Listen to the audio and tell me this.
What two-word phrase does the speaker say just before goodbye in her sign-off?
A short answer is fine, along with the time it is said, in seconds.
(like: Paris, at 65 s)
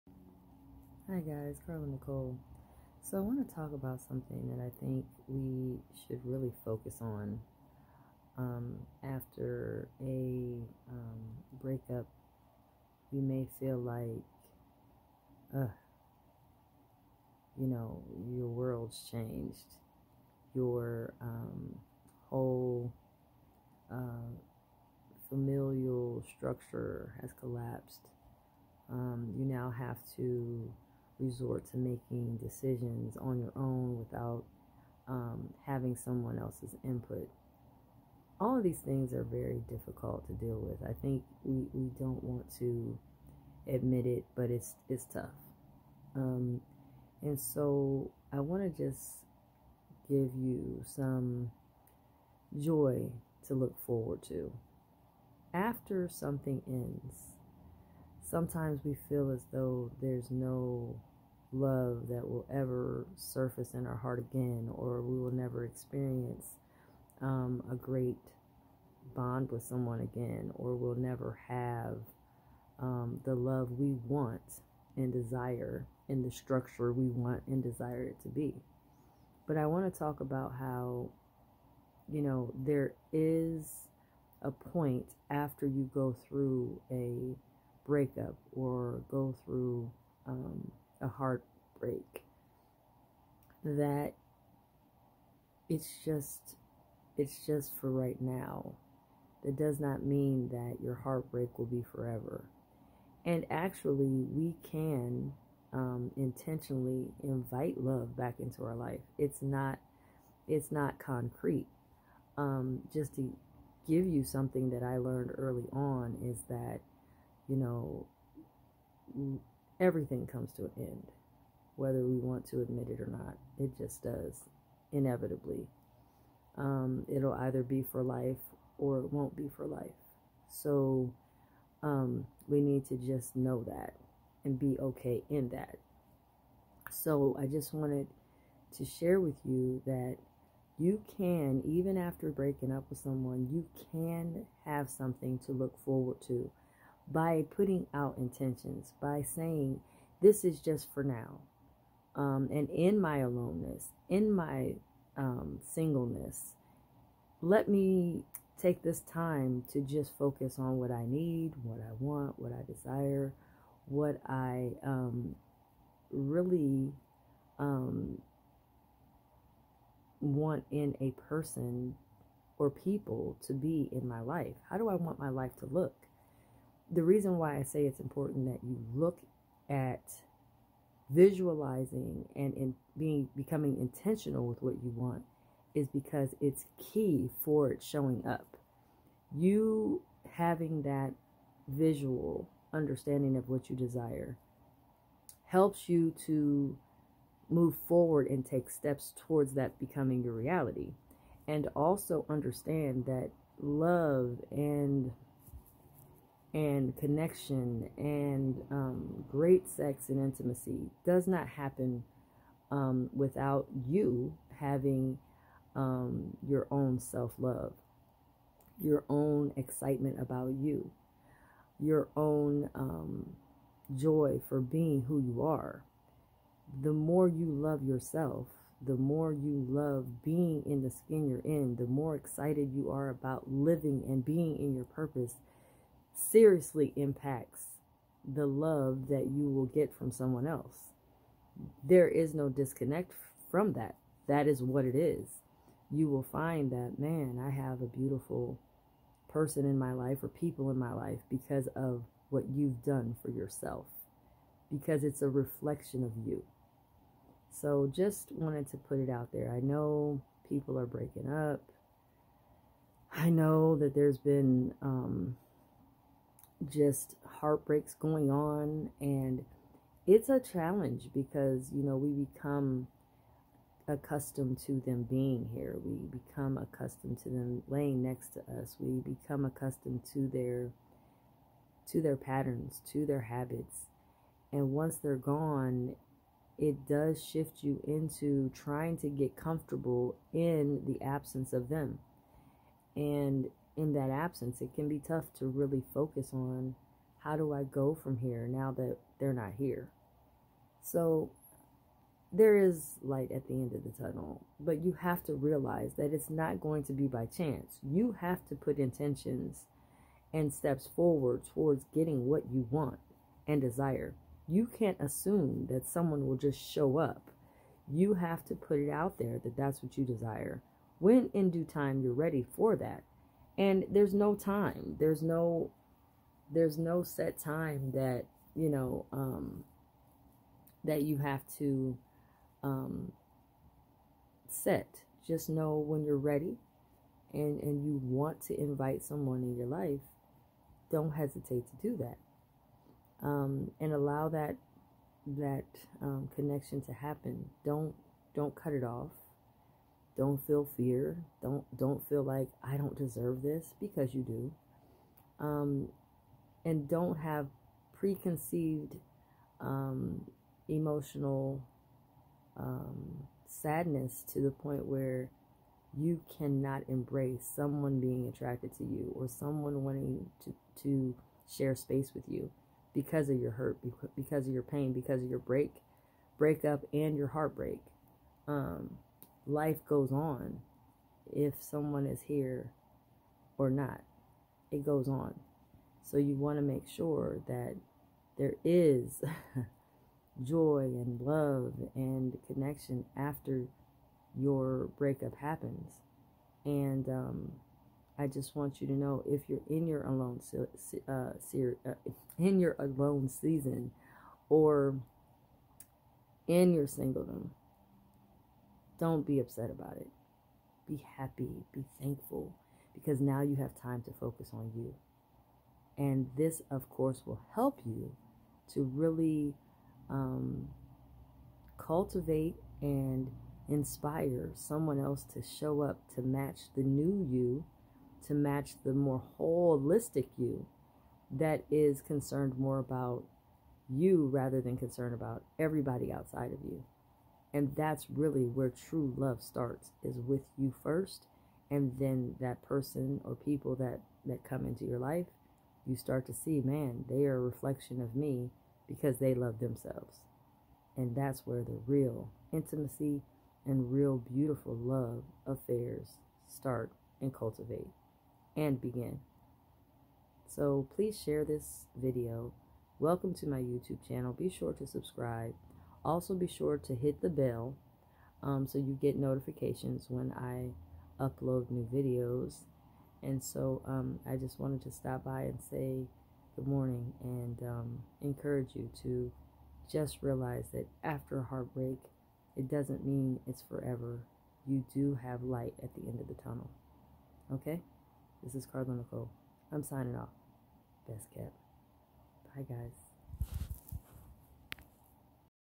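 Best kept, at 491 s.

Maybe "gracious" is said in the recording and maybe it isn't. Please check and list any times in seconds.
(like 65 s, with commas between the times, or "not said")
not said.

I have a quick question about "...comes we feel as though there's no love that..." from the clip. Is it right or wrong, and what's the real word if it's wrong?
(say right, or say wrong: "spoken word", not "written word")
wrong: "sometimes", not "comes".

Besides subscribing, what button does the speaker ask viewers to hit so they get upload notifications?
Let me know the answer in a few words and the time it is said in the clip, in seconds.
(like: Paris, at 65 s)
The bell, at 467 s.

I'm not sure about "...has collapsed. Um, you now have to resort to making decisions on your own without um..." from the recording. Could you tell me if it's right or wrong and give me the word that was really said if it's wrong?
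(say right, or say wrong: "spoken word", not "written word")
right.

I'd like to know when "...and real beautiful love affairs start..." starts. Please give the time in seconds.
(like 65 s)
453 s.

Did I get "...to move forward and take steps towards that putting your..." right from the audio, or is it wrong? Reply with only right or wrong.
wrong.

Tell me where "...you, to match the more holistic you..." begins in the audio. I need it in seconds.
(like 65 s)
427 s.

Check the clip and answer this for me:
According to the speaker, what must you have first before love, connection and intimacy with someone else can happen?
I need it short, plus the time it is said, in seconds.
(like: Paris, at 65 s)
Your own self love, at 216 s.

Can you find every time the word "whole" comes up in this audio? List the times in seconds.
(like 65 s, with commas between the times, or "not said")
22 s.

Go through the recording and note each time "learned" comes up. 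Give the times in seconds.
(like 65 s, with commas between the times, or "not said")
114 s.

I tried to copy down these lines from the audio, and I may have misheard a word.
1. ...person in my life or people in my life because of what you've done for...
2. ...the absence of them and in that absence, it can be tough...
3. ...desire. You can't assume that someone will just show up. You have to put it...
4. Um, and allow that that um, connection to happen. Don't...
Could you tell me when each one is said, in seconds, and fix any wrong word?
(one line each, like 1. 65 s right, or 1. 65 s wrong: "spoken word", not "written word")
1. 249 s right
2. 290 s right
3. 313 s right
4. 343 s right.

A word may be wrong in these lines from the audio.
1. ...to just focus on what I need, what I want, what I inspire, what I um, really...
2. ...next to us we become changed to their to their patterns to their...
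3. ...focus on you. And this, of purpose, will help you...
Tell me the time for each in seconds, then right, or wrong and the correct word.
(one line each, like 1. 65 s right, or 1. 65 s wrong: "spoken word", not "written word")
1. 159 s wrong: "desire", not "inspire"
2. 278 s wrong: "accustomed", not "changed"
3. 414 s wrong: "course", not "purpose".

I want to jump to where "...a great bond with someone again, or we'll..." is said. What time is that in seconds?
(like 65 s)
67 s.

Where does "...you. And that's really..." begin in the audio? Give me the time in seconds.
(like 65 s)
436 s.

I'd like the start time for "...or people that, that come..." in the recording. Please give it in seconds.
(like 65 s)
443 s.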